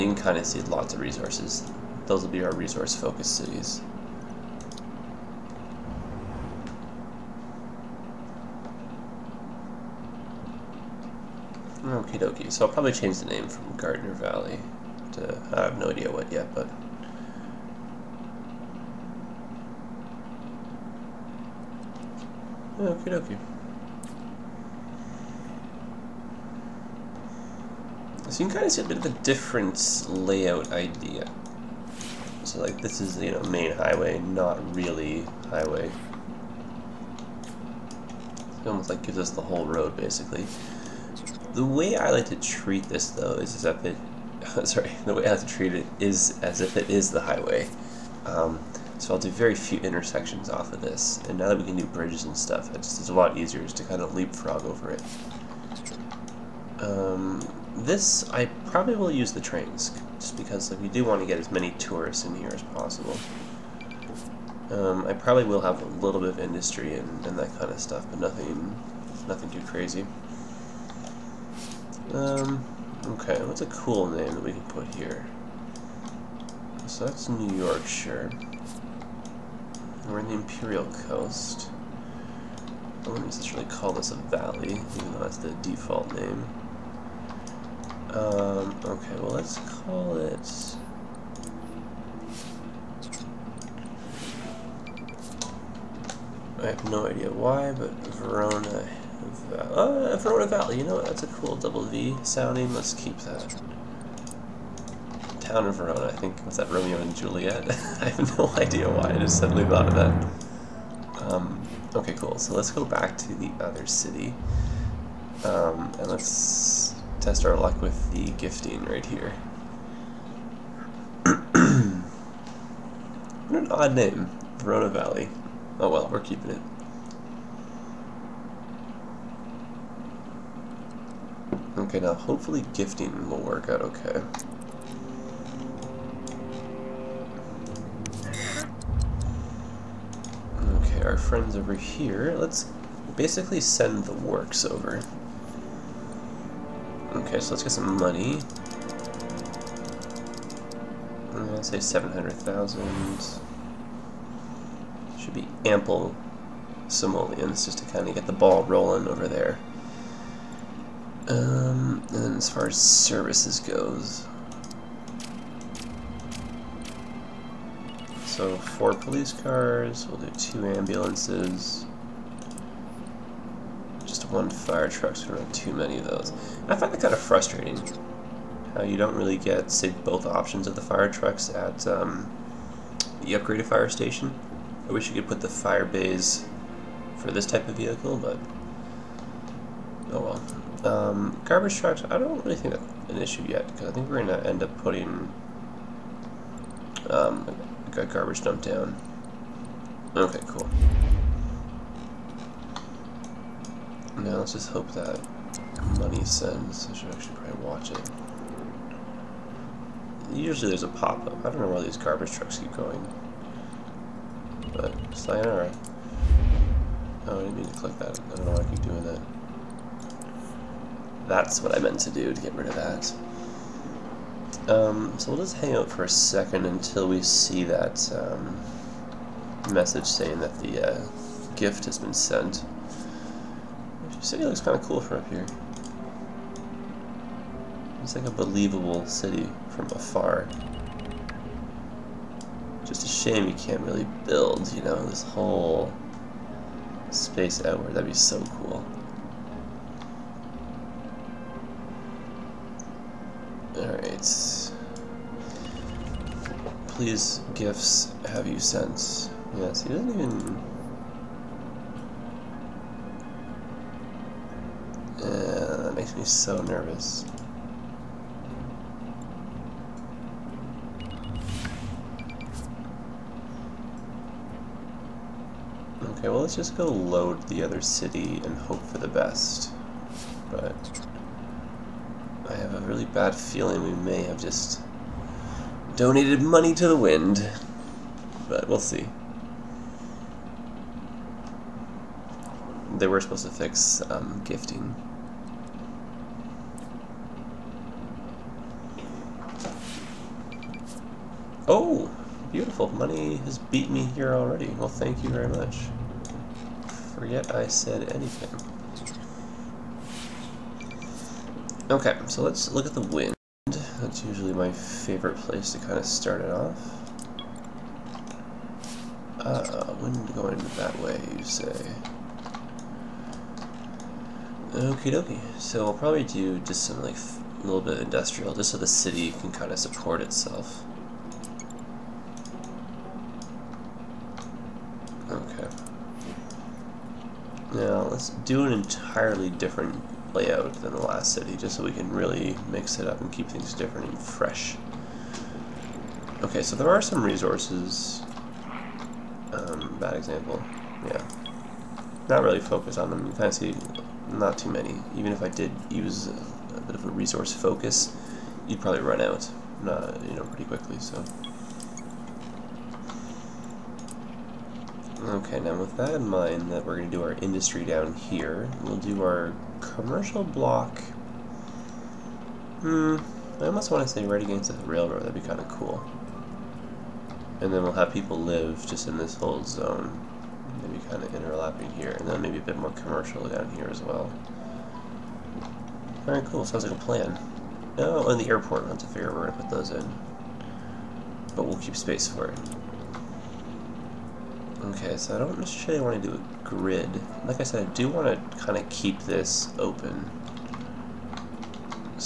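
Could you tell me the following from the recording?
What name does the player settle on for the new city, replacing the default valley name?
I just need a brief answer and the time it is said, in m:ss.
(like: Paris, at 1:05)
Verona Valley, at 1:38.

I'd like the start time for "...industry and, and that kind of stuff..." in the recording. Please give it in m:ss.
1:06.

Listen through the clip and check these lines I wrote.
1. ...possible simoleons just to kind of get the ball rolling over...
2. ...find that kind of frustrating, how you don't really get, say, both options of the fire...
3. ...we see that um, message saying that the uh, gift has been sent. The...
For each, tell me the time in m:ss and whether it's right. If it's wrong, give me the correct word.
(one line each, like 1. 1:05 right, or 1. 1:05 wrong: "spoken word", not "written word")
1. 2:35 wrong: "ample", not "possible"
2. 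2:56 right
3. 3:47 right.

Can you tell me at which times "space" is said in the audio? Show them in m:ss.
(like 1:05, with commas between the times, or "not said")
4:07, 6:31.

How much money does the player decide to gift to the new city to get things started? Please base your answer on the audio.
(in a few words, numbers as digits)
700,000.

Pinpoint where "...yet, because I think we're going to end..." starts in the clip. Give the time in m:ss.
3:13.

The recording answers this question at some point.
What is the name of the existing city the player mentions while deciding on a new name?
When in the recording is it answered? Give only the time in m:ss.
1:17.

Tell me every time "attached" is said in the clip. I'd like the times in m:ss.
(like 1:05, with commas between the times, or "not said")
not said.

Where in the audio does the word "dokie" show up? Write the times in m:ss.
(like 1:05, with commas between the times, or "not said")
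0:12, 0:23, 5:25.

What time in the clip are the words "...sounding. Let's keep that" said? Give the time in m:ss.
1:42.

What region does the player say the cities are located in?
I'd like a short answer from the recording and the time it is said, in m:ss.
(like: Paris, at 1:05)
Imperial Coast, at 1:20.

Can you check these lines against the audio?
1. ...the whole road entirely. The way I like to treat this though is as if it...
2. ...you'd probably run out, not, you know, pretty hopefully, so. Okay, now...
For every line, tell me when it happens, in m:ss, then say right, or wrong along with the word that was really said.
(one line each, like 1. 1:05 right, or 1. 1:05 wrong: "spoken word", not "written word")
1. 0:39 wrong: "basically", not "entirely"
2. 5:58 wrong: "quickly", not "hopefully".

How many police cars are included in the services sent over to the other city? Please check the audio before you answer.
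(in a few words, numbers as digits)
4.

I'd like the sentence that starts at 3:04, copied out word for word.
I wish you could put the fire bays for this type of vehicle, but oh well.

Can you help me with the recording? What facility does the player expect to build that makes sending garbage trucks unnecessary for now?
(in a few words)
garbage dump.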